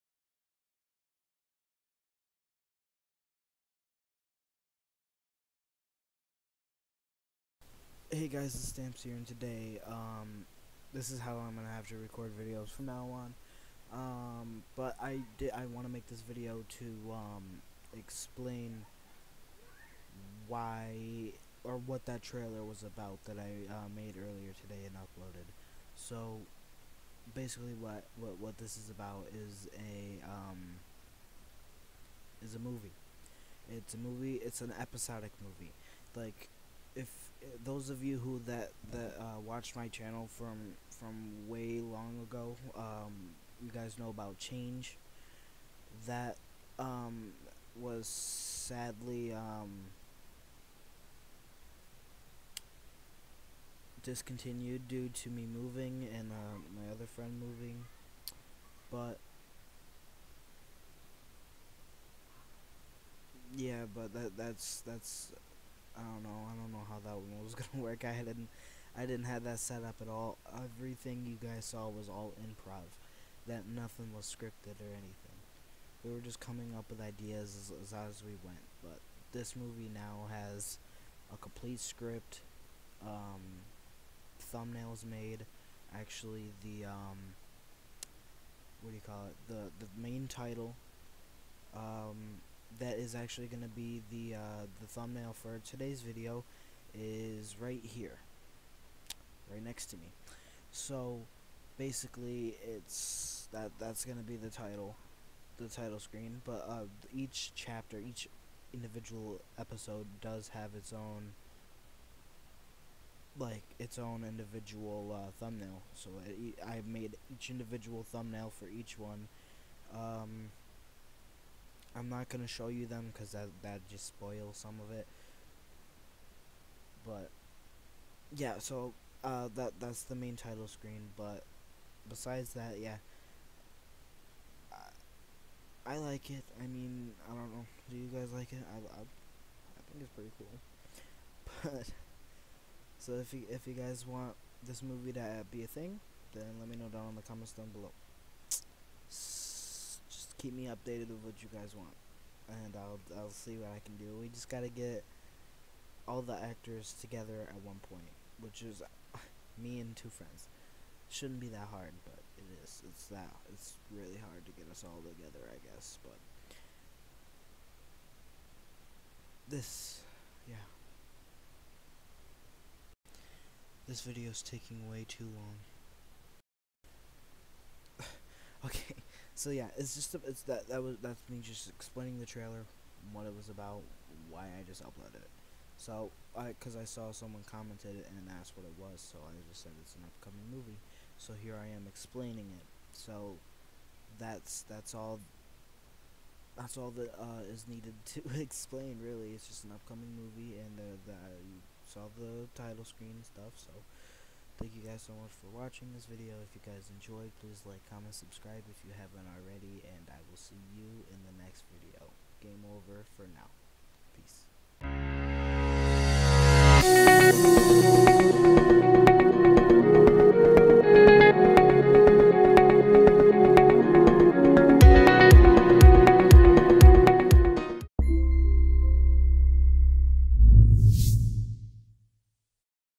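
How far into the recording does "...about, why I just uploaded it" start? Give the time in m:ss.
3:03.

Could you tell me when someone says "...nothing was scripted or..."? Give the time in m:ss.
1:13.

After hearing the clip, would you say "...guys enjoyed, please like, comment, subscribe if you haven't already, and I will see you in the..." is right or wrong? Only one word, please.
right.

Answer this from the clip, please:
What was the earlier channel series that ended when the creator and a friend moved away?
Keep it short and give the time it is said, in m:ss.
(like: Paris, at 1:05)
Change, at 0:44.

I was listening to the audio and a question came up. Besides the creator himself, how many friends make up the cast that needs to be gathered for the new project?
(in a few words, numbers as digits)
2.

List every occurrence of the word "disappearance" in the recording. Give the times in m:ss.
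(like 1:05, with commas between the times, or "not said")
not said.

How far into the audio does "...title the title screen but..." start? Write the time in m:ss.
1:44.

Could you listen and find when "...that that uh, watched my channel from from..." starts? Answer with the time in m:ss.
0:38.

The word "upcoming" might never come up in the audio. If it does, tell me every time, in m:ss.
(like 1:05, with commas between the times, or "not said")
3:10, 3:19.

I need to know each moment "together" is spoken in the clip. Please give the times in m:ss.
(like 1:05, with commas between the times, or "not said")
2:36, 2:45.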